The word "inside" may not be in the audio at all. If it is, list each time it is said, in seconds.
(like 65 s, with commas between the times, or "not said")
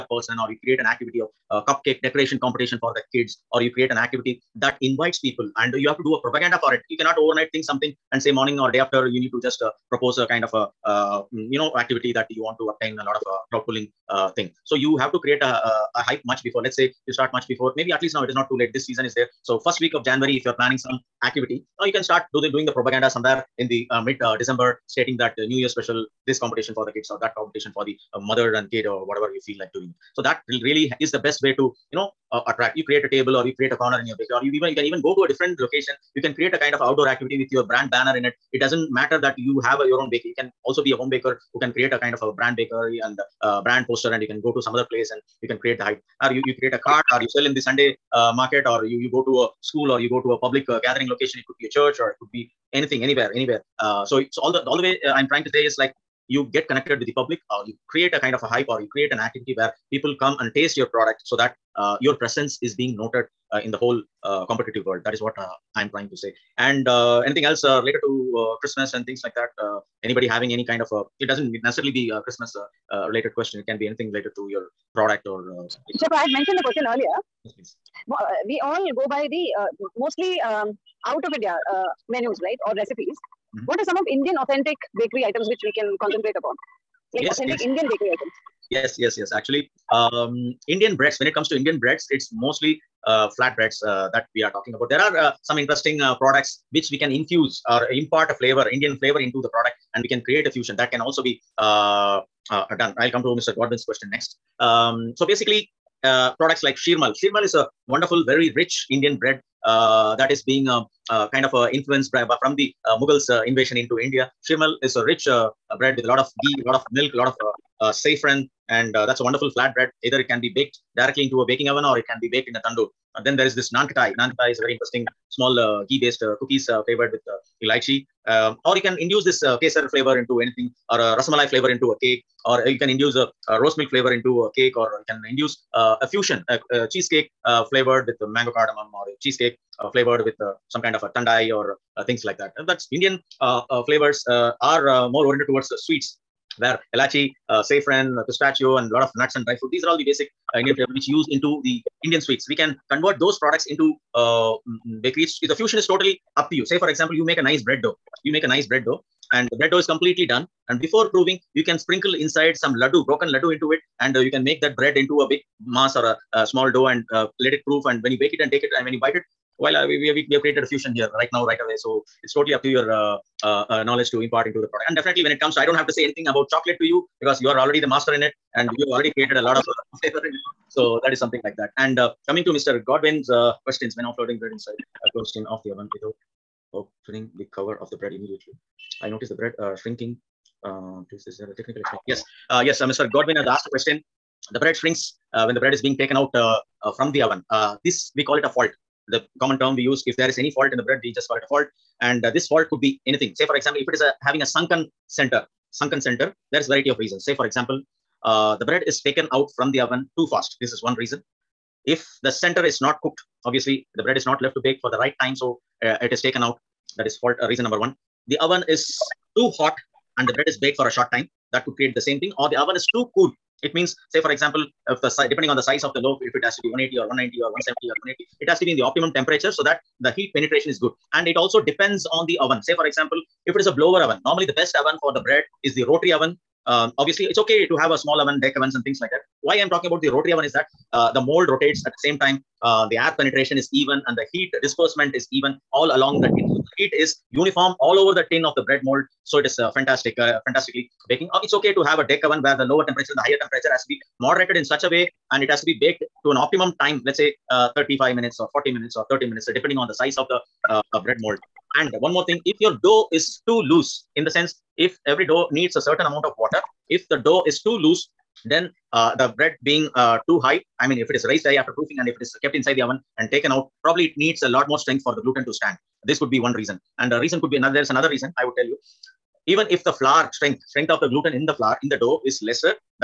162 s, 184 s, 272 s.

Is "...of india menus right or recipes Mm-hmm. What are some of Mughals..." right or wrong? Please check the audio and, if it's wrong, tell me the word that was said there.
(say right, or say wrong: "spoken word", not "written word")
wrong: "Indian", not "Mughals".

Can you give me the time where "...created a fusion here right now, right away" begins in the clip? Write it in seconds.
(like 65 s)
170 s.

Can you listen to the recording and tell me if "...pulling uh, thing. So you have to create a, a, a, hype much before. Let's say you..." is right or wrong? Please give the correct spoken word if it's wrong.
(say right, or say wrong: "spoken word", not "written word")
right.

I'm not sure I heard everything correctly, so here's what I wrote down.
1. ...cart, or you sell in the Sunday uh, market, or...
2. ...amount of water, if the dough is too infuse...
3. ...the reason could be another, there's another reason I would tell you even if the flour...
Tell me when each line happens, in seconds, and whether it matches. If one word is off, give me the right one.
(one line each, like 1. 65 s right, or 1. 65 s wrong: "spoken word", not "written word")
1. 46 s right
2. 266 s wrong: "loose", not "infuse"
3. 277 s right.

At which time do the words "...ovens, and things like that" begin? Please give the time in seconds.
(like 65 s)
238 s.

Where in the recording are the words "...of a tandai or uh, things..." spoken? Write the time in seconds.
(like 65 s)
140 s.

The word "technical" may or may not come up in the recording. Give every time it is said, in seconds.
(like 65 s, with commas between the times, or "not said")
191 s.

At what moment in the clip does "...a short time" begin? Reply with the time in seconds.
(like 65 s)
220 s.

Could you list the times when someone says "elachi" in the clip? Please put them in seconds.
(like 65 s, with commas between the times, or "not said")
146 s.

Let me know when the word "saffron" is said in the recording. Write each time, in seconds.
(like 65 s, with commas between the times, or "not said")
117 s, 147 s.